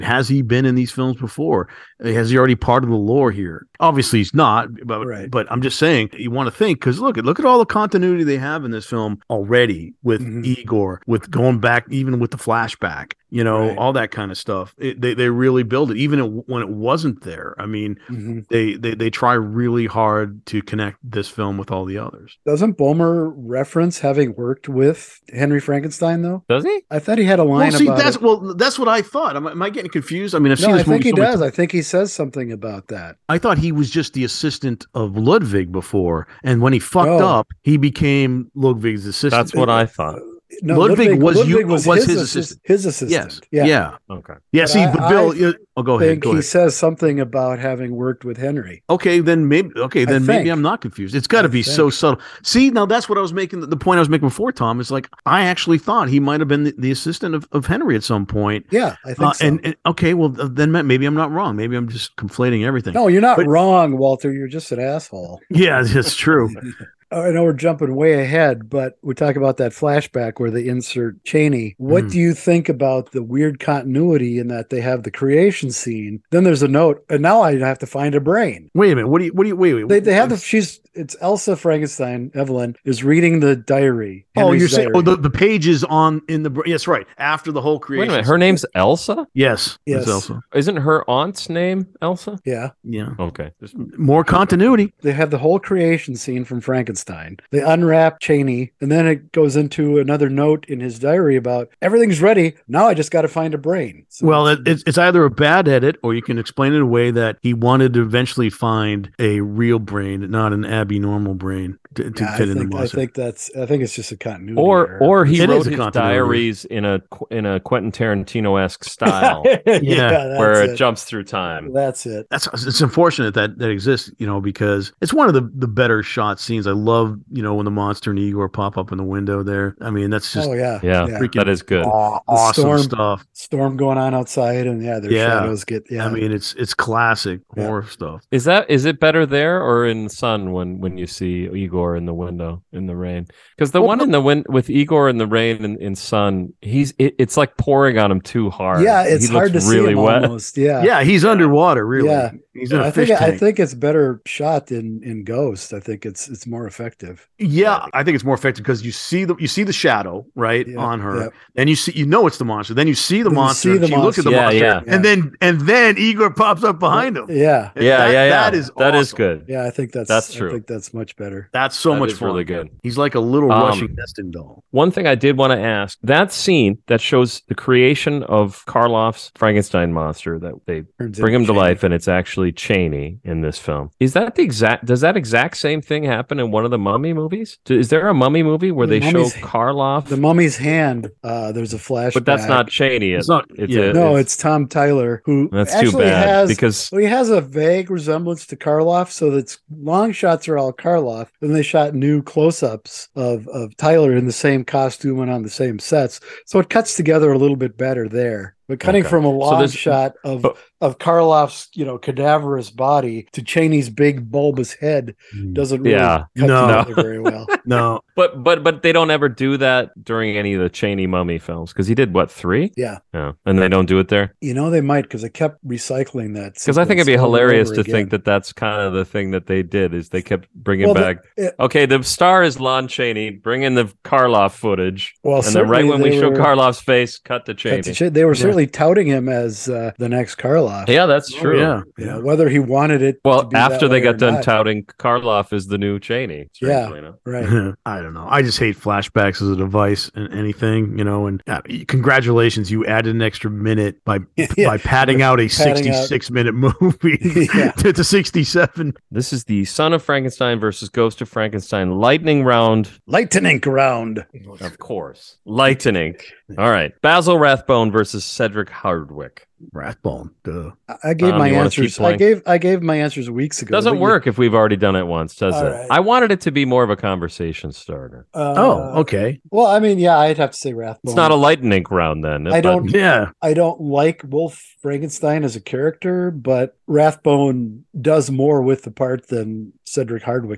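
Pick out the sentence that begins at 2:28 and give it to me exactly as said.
Yeah, it's he hard to really see wet.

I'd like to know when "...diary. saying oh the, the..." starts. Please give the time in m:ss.
1:24.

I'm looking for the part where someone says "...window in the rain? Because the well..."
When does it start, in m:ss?
2:22.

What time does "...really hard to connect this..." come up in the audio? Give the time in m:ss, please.
0:19.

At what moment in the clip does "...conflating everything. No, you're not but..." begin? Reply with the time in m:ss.
1:02.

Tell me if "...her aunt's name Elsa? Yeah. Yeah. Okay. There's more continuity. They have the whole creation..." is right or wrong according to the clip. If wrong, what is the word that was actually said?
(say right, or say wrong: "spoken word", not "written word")
right.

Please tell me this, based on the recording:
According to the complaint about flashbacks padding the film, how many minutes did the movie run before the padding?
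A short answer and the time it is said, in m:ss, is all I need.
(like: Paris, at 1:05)
66, at 4:15.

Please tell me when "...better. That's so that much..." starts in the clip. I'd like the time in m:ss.
2:51.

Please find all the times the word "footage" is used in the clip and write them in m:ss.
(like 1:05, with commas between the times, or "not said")
3:54.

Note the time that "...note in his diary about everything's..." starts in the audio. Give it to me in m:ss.
1:40.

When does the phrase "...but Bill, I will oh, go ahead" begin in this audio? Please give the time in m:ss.
0:44.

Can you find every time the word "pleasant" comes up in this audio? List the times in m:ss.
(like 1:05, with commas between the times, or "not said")
not said.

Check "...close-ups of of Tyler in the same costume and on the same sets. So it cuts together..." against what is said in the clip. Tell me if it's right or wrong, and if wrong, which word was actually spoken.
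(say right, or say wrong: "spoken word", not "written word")
right.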